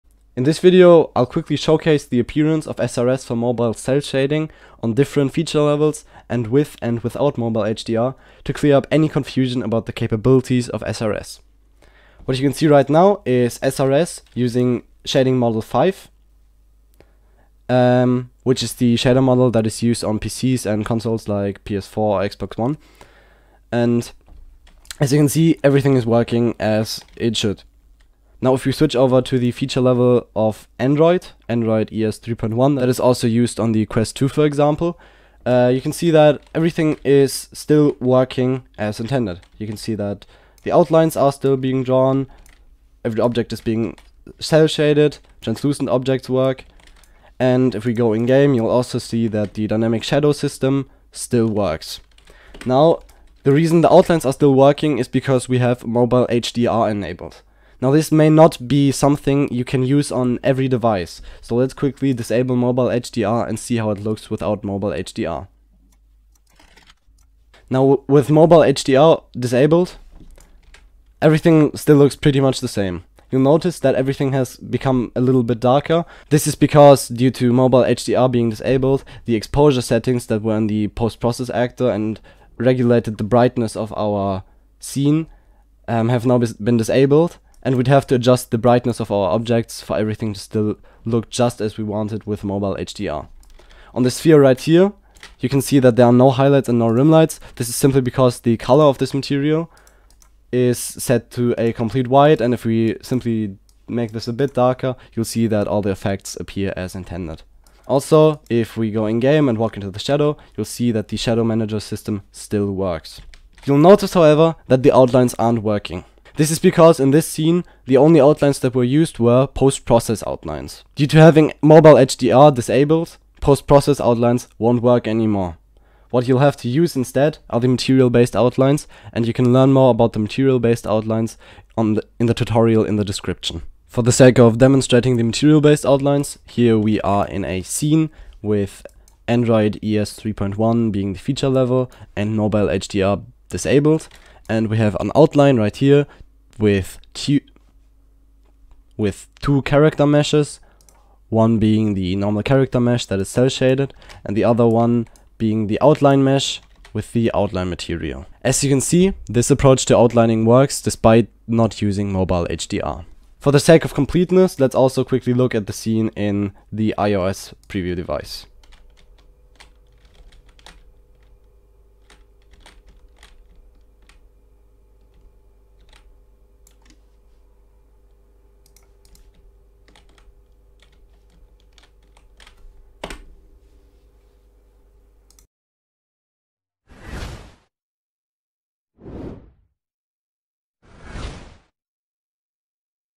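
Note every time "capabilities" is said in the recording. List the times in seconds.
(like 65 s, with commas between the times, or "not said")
9 s.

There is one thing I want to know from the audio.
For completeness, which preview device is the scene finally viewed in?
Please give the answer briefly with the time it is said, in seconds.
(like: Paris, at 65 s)
iOS preview device, at 166 s.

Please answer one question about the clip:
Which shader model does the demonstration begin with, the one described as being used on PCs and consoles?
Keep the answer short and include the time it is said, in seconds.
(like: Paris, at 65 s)
Shading model 5, at 15 s.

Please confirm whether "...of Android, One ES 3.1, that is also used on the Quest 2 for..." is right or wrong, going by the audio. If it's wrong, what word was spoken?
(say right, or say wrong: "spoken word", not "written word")
wrong: "Android", not "One".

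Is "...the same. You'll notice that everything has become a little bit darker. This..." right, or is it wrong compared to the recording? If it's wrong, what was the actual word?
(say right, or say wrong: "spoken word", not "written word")
right.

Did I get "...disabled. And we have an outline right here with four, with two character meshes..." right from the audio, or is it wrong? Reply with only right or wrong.
wrong.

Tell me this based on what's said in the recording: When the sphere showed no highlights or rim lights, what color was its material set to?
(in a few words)
White.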